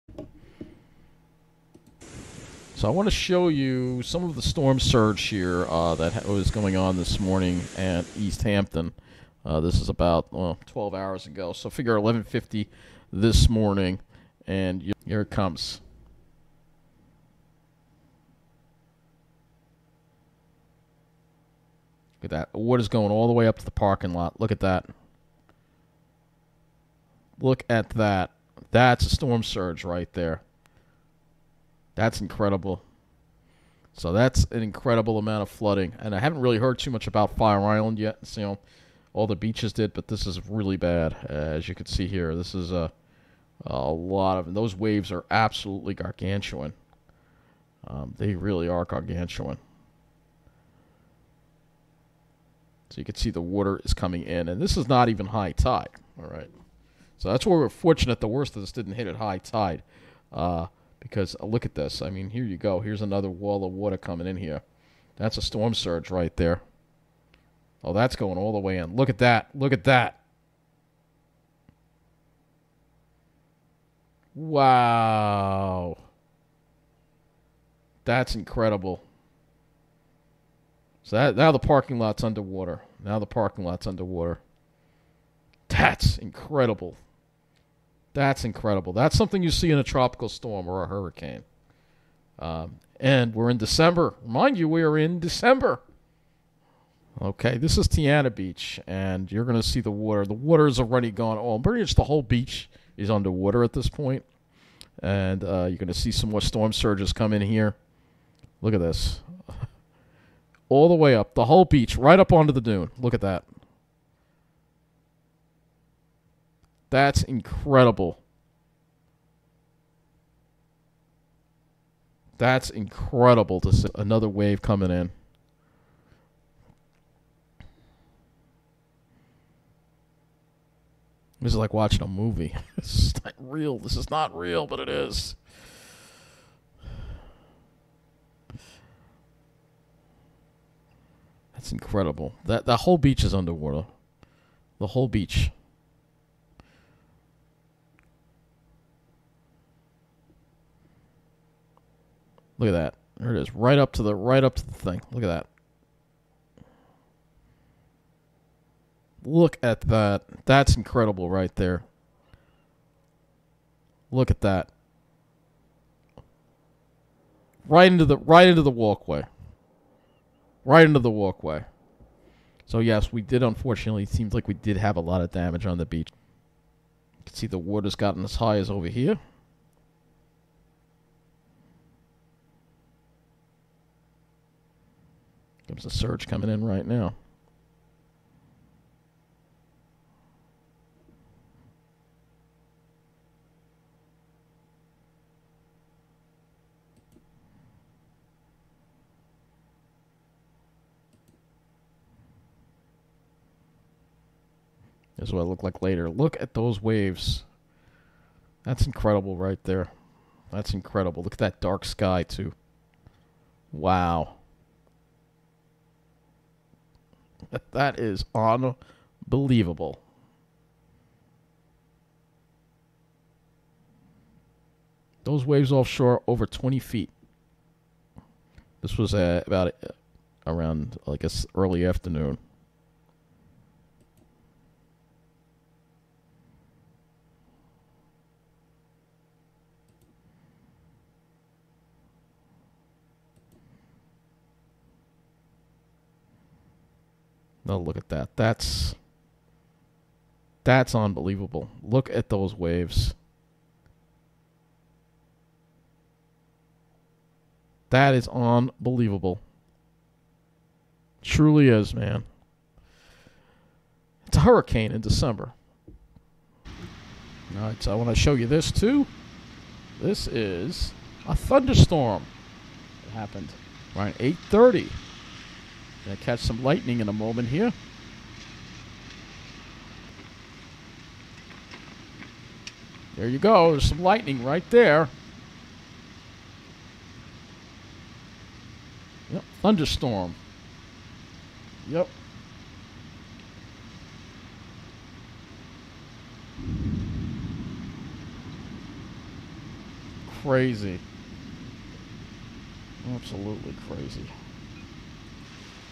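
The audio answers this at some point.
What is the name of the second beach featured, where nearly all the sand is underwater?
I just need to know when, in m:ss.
1:37.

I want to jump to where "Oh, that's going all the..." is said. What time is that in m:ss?
1:07.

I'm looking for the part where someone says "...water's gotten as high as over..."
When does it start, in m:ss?
2:57.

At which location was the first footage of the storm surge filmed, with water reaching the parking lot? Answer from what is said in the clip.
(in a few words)
East Hampton.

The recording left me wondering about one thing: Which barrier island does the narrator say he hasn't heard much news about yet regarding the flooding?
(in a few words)
Fire Island.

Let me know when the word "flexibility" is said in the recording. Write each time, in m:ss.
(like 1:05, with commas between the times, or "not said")
not said.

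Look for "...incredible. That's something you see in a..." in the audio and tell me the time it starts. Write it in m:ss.
1:28.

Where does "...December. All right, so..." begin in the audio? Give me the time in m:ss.
4:24.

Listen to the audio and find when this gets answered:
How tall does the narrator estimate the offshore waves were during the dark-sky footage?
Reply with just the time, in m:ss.
3:46.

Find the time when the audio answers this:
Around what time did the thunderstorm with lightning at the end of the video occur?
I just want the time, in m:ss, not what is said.
4:34.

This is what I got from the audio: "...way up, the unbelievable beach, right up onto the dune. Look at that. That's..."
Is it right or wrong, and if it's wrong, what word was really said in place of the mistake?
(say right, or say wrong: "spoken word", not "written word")
wrong: "whole", not "unbelievable".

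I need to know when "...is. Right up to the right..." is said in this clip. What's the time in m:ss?
2:33.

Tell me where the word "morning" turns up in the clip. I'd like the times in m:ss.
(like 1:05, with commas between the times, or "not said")
0:07, 0:13.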